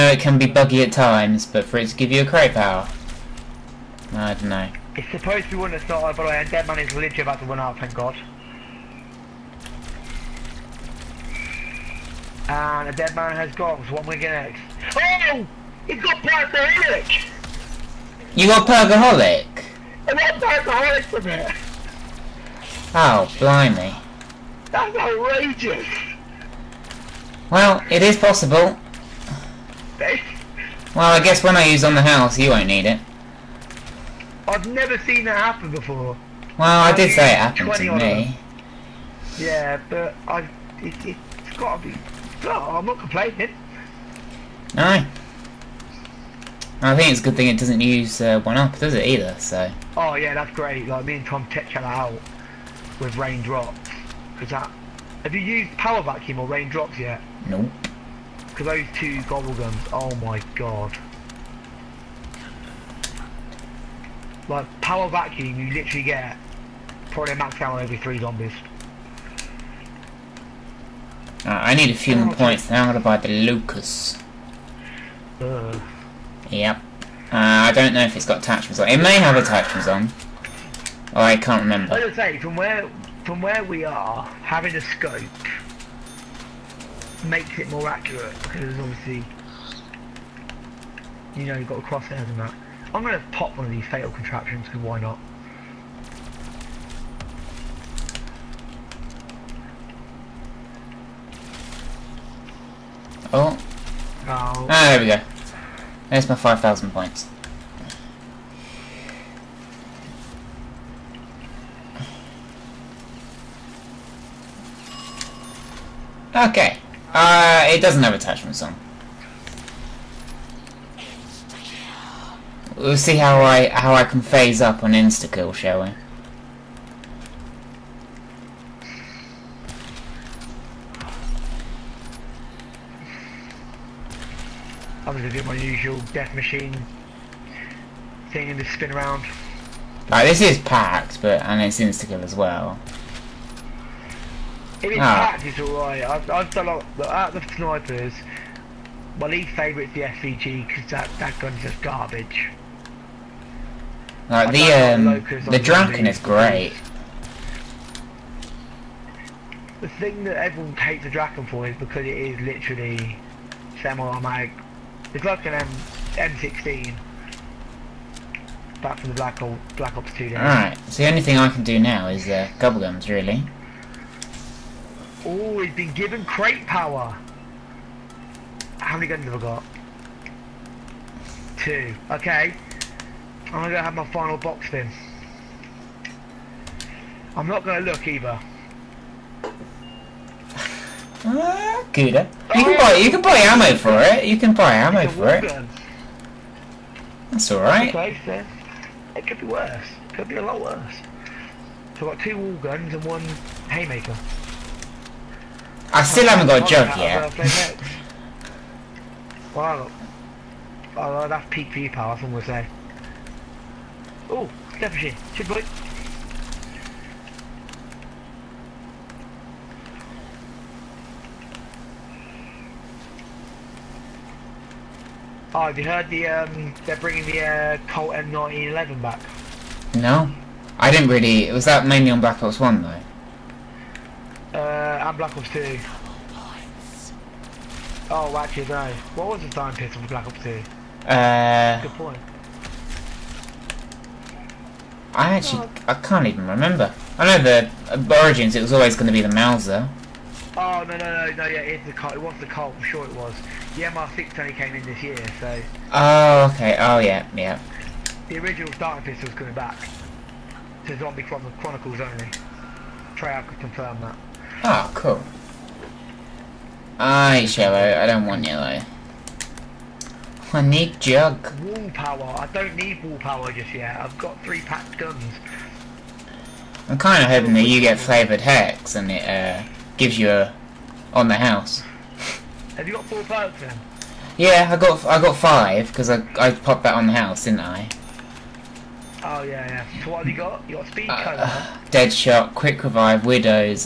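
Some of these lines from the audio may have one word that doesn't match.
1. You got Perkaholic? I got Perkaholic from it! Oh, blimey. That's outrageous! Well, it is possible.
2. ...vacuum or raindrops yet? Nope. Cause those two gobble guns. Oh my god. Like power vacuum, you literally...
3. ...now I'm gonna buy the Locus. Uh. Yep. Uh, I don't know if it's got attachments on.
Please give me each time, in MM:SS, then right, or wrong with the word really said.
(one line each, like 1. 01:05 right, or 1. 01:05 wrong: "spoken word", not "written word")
1. 00:18 right
2. 00:56 right
3. 01:12 right.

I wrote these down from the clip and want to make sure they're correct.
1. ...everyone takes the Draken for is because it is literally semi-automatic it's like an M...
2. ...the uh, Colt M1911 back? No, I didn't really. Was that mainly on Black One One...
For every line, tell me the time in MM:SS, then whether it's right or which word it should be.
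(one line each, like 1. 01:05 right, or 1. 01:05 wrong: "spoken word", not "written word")
1. 02:40 right
2. 03:47 wrong: "Ops", not "One".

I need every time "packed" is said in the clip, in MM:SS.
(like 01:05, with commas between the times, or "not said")
02:20, 02:25, 04:34.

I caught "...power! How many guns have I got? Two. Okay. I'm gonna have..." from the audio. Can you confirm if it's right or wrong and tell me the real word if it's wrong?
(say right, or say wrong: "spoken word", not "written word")
right.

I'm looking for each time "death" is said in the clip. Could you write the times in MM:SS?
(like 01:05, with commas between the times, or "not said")
02:16.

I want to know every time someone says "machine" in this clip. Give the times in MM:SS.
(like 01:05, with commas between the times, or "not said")
02:16, 03:34.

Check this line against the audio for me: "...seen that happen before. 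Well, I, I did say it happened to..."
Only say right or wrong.
right.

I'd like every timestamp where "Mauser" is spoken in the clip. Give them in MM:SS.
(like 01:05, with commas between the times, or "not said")
04:09.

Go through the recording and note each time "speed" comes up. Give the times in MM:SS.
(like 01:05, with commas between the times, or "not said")
04:50.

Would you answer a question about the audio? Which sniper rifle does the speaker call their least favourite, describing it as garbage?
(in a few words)
SVG.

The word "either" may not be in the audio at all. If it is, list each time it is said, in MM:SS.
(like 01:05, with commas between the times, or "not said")
00:49, 03:08.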